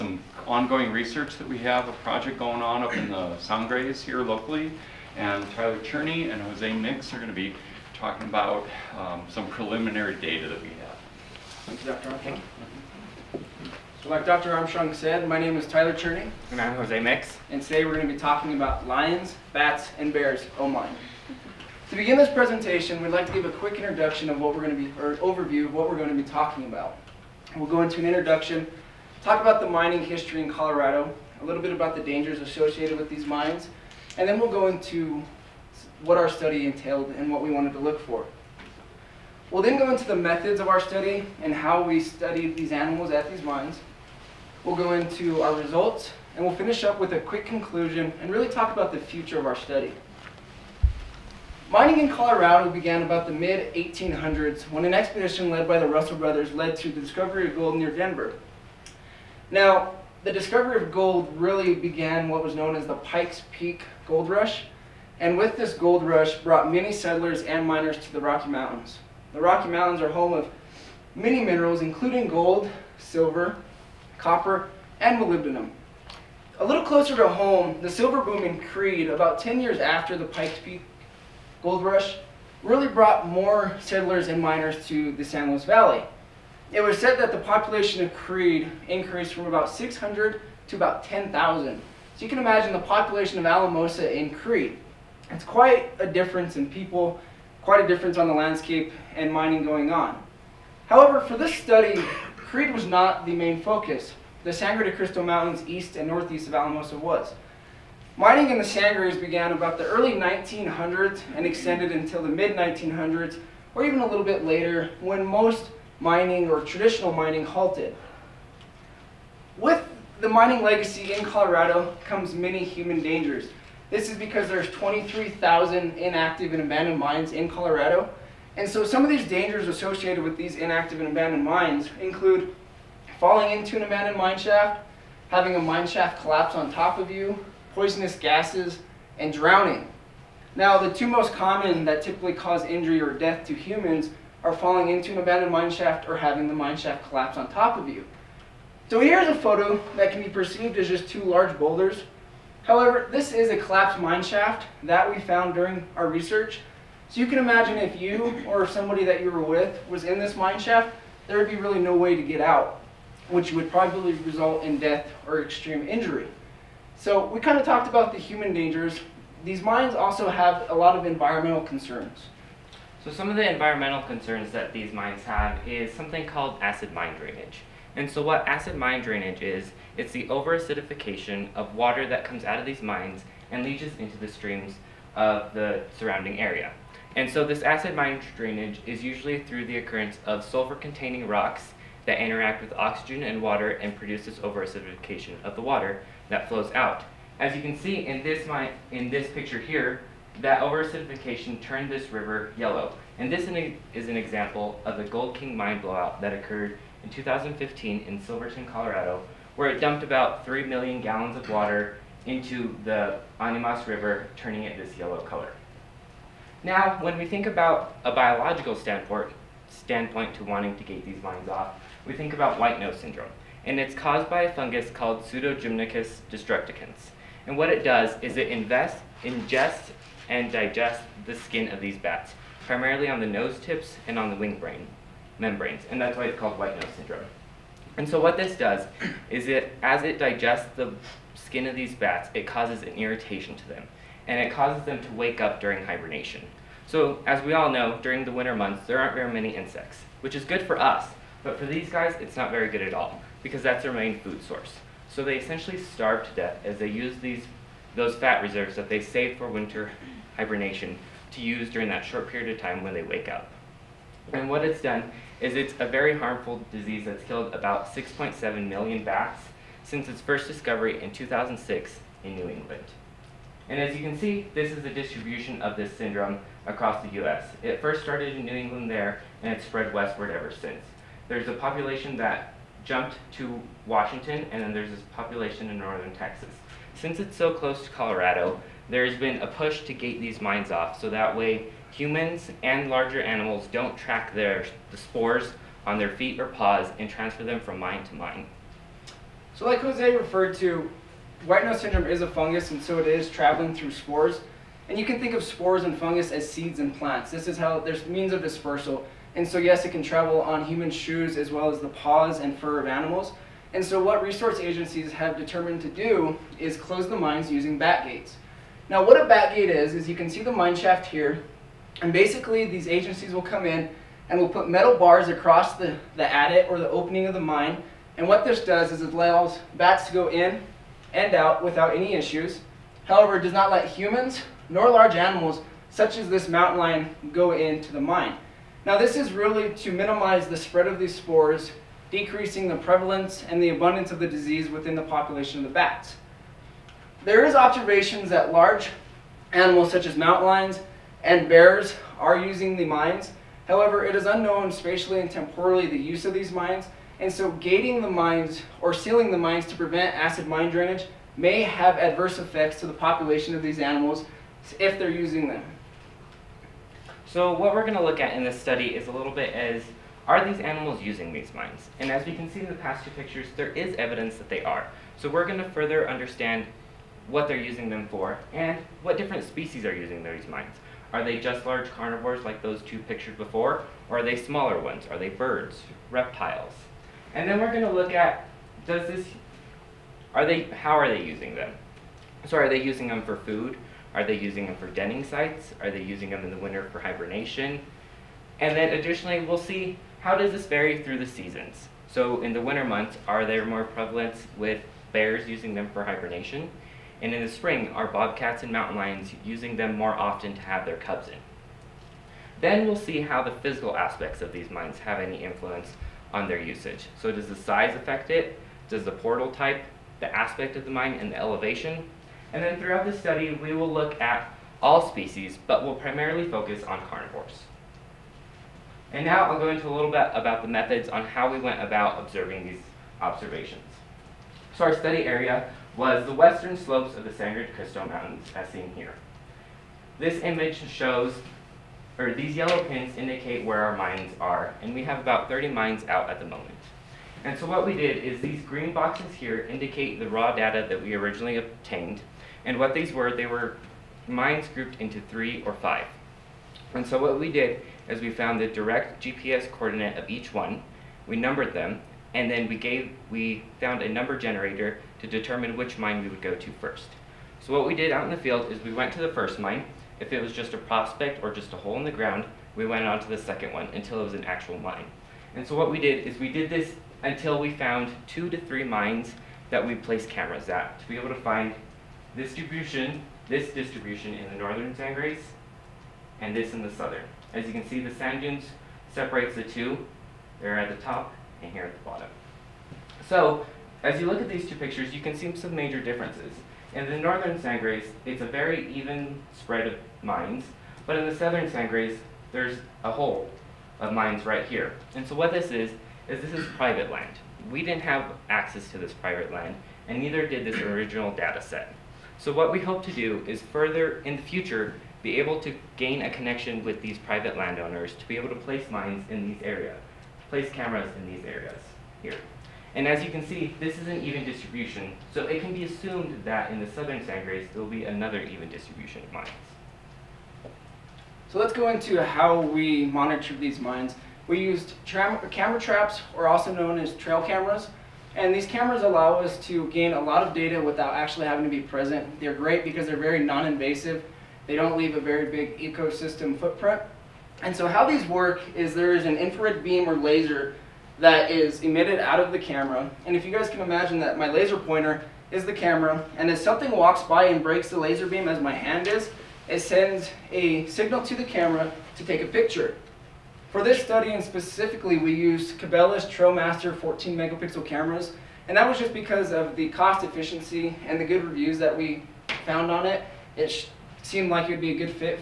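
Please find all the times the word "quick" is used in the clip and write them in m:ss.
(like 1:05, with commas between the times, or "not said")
0:23, 0:47.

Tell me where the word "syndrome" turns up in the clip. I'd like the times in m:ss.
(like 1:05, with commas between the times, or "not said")
3:42, 3:56, 4:35, 5:01.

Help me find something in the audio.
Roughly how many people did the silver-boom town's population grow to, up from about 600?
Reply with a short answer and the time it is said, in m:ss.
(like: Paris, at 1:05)
10,000, at 1:31.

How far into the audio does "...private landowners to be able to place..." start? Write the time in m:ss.
8:37.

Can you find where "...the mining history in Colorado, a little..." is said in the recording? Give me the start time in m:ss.
0:29.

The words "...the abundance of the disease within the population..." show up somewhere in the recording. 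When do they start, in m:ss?
5:43.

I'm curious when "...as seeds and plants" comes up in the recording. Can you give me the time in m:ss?
5:06.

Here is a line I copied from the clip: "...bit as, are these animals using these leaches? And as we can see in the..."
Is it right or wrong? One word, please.
wrong.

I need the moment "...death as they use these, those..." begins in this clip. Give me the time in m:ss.
4:16.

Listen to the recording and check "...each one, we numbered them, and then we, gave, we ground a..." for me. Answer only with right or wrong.
wrong.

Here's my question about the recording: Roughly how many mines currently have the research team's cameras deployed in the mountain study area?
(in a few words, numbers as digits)
30.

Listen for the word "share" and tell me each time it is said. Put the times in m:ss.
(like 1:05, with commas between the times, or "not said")
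not said.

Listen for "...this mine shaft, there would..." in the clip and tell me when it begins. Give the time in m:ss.
2:40.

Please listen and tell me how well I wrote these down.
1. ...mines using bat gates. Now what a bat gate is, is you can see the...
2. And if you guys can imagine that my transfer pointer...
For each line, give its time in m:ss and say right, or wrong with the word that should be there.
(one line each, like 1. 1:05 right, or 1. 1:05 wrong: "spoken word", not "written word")
1. 5:17 right
2. 9:13 wrong: "laser", not "transfer".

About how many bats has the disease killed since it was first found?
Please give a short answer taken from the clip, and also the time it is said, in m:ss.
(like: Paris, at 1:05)
6.7 million, at 4:27.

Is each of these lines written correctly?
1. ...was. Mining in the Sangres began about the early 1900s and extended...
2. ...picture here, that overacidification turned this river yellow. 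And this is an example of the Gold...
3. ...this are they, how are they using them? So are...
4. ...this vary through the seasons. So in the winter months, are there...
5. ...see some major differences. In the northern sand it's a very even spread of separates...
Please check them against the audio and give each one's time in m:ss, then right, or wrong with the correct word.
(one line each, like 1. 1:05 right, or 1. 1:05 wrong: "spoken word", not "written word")
1. 1:46 right
2. 3:19 right
3. 6:29 right
4. 6:40 right
5. 8:15 wrong: "mines", not "separates".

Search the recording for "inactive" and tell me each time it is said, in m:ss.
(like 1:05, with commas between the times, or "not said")
2:05, 2:10.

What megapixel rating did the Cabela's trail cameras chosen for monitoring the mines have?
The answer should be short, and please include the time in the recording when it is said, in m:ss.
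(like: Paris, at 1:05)
14 megapixels, at 9:26.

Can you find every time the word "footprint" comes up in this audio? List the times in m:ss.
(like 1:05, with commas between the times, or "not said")
9:06.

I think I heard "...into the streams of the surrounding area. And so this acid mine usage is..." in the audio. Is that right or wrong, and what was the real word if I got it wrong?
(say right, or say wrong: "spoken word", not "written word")
wrong: "drainage", not "usage".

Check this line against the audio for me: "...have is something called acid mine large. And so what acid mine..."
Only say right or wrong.
wrong.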